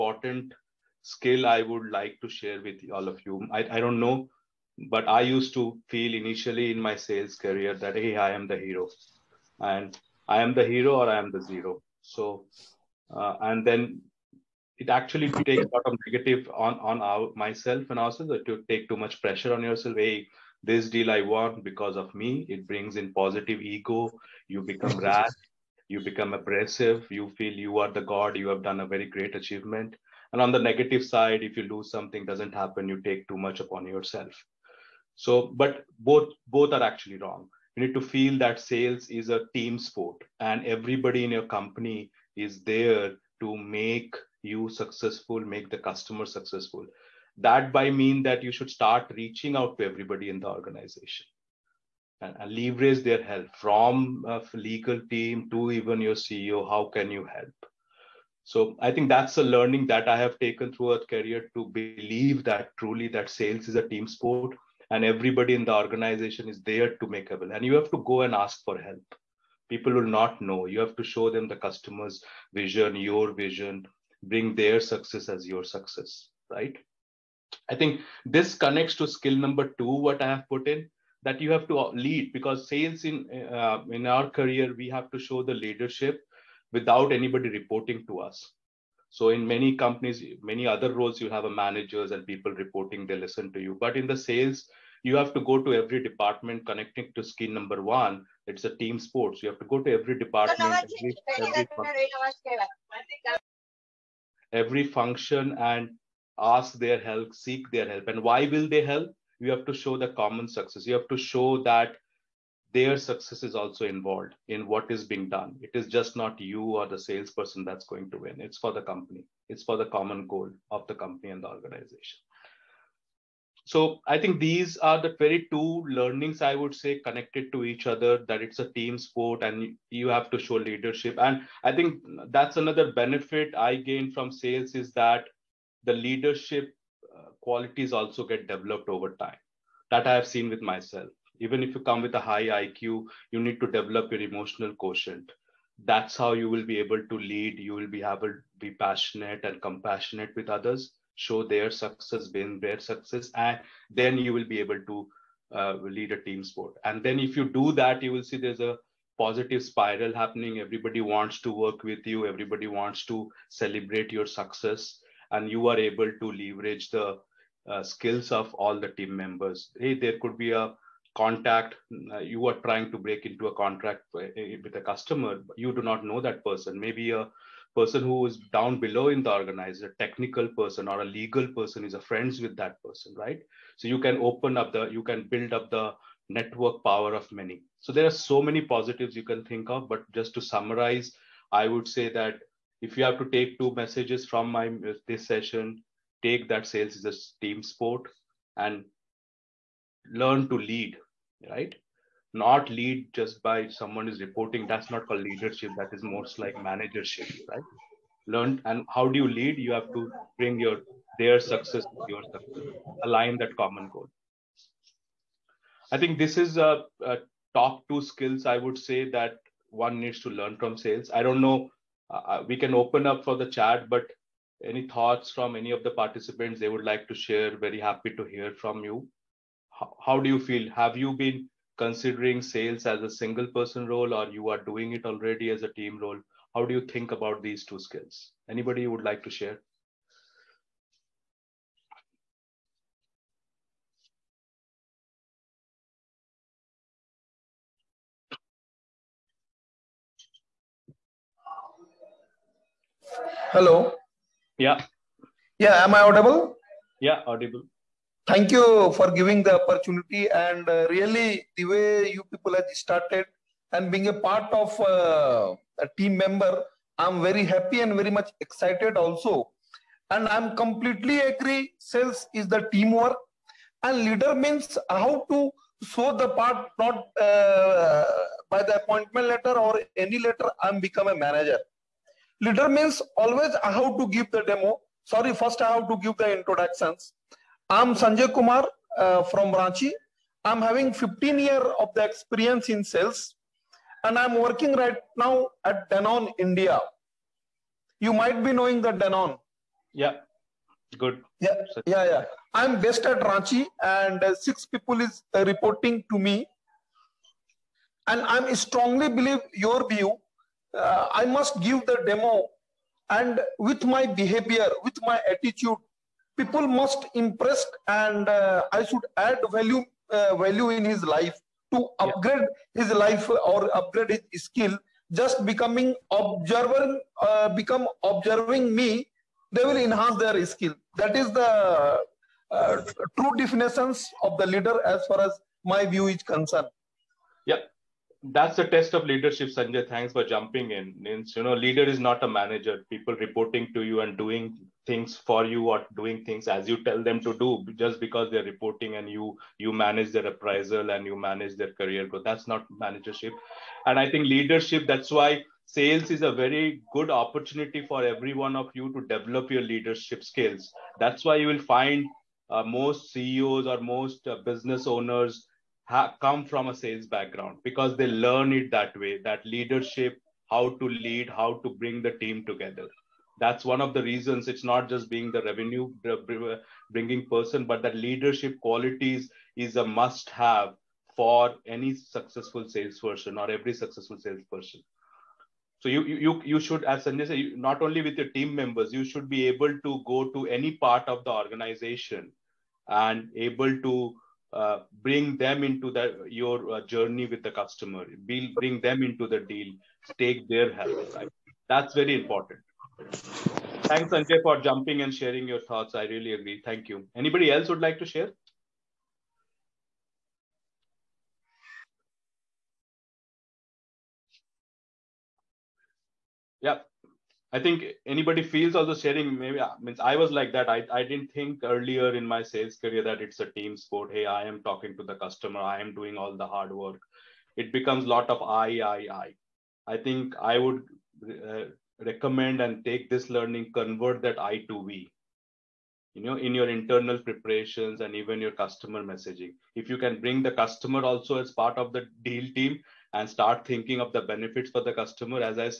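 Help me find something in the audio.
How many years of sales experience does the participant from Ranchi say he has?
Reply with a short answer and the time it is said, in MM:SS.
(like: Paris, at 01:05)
15, at 04:50.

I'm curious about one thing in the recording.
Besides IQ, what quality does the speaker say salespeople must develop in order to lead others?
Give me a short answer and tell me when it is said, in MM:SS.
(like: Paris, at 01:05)
emotional quotient, at 02:24.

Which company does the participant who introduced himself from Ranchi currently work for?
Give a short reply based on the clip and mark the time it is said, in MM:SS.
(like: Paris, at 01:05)
Danone India, at 04:55.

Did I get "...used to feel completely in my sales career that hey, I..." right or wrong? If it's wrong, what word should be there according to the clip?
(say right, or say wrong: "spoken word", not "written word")
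wrong: "initially", not "completely".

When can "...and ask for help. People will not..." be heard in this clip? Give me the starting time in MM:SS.
01:08.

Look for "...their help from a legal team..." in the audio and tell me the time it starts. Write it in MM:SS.
00:53.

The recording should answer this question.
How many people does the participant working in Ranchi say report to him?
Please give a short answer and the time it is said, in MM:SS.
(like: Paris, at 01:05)
6, at 05:04.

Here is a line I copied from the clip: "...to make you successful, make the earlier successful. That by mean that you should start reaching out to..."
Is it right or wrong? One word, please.
wrong.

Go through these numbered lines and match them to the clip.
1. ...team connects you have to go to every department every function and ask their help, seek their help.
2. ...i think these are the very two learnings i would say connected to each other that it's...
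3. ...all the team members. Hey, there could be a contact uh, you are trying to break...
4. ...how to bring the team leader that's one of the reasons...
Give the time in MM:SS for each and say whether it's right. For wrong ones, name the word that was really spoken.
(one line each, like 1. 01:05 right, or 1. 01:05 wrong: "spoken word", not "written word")
1. 01:38 wrong: "sports", not "connects"
2. 02:04 right
3. 02:48 right
4. 06:11 wrong: "together", not "leader".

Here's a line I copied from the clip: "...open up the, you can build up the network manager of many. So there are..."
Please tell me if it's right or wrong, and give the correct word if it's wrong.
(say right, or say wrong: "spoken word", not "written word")
wrong: "power", not "manager".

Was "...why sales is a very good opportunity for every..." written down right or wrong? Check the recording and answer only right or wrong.
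right.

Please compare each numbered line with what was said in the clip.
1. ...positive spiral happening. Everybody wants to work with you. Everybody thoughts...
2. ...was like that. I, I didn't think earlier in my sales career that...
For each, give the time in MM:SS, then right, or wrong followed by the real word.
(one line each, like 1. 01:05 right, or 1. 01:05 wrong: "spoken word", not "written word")
1. 02:39 wrong: "wants", not "thoughts"
2. 07:00 right.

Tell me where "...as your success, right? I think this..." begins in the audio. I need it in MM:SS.
01:15.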